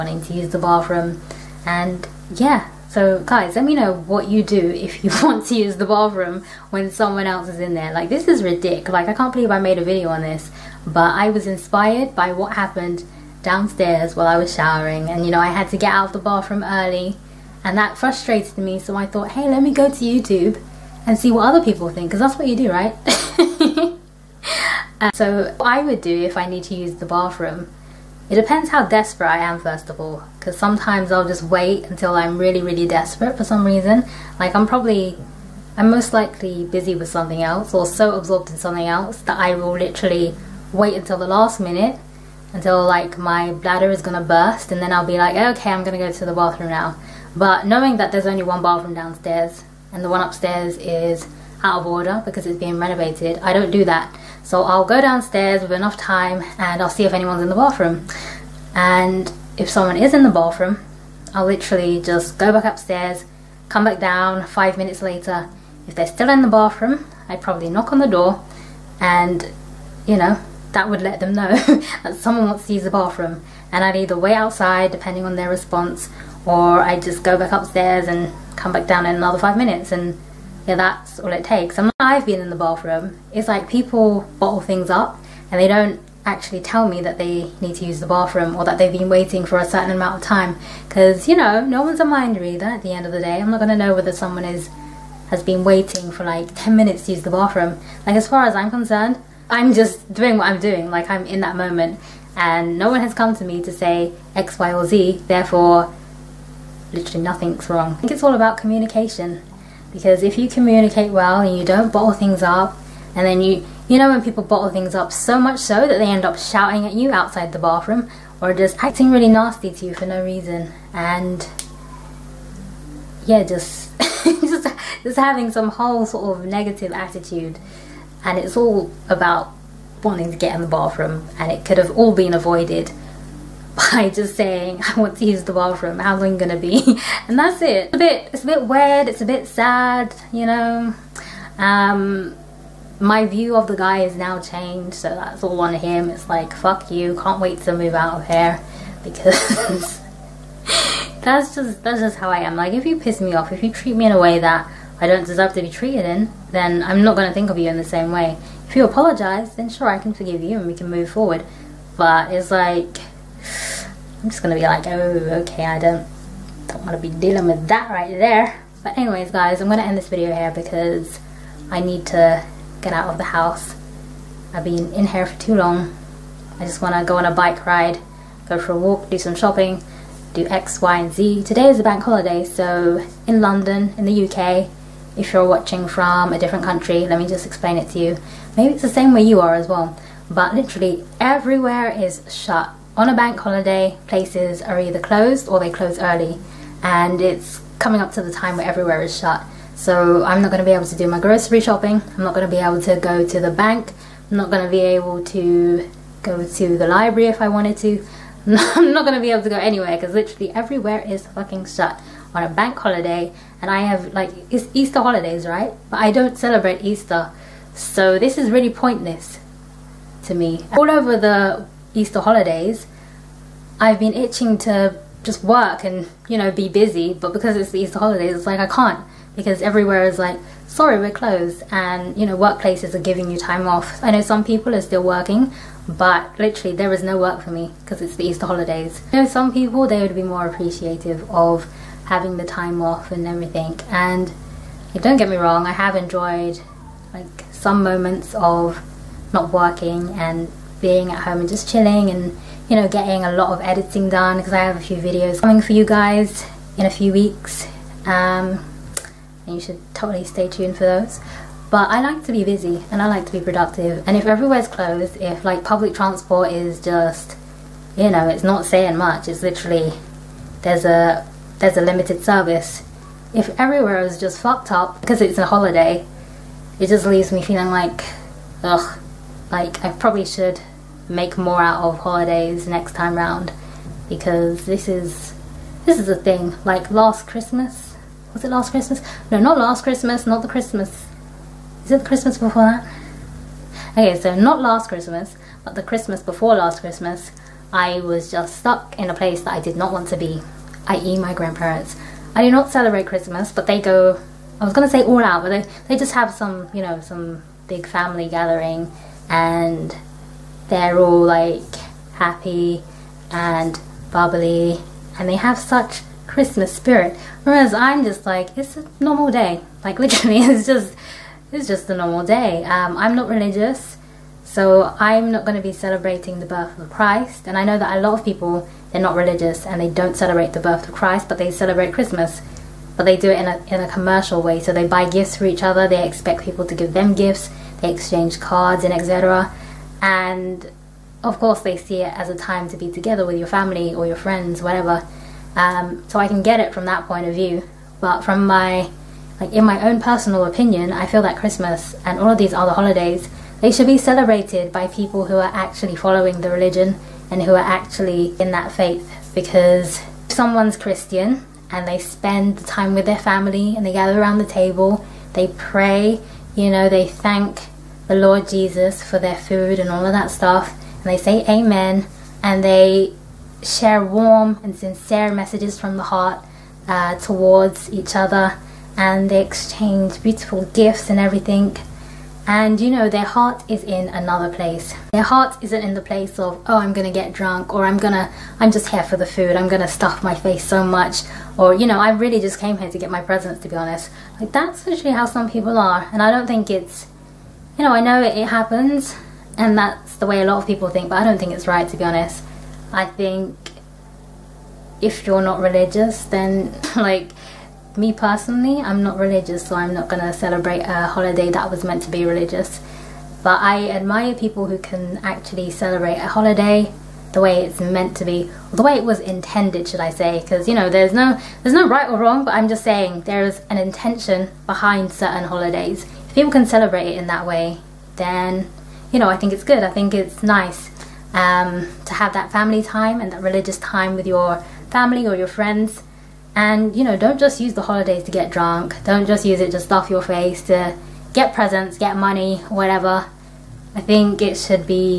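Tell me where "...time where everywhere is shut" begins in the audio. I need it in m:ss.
3:18.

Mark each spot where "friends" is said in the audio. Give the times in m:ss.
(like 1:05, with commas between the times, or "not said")
5:44, 7:15.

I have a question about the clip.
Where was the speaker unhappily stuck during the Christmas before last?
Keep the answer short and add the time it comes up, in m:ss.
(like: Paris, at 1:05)
Grandparents, at 5:01.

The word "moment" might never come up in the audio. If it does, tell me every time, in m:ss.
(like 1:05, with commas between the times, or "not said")
1:41, 4:07.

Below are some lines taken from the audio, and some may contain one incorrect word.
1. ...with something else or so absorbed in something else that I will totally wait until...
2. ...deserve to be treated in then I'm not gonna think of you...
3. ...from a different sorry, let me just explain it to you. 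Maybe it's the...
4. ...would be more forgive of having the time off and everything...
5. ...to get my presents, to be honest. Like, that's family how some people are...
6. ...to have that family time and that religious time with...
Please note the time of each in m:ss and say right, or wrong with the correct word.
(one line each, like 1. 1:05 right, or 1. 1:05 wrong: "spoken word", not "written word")
1. 0:36 wrong: "literally", not "totally"
2. 2:35 right
3. 3:05 wrong: "country", not "sorry"
4. 4:00 wrong: "appreciative", not "forgive"
5. 6:32 wrong: "literally", not "family"
6. 7:12 right.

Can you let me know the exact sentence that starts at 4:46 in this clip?
Like last Christmas, was it last Christmas?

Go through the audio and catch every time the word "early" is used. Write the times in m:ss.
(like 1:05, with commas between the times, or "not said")
0:16, 3:15.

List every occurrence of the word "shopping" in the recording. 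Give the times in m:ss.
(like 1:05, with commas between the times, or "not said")
2:59, 3:21.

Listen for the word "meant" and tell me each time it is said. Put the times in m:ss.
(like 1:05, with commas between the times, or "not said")
6:51, 6:57.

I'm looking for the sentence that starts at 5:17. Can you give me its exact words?
Whereas I'm just like, it's a normal day.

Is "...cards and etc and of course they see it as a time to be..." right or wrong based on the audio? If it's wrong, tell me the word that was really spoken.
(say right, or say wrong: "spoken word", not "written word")
right.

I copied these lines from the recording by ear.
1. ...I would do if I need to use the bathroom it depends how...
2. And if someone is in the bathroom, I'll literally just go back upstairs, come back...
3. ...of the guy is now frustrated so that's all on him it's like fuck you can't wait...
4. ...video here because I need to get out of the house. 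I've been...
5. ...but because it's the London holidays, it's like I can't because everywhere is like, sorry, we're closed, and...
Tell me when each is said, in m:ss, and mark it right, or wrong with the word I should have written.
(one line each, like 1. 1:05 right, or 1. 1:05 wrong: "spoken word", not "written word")
1. 0:25 right
2. 0:58 right
3. 2:23 wrong: "changed", not "frustrated"
4. 2:50 right
5. 3:47 wrong: "Easter", not "London".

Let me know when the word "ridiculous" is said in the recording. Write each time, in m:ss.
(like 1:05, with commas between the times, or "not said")
0:08.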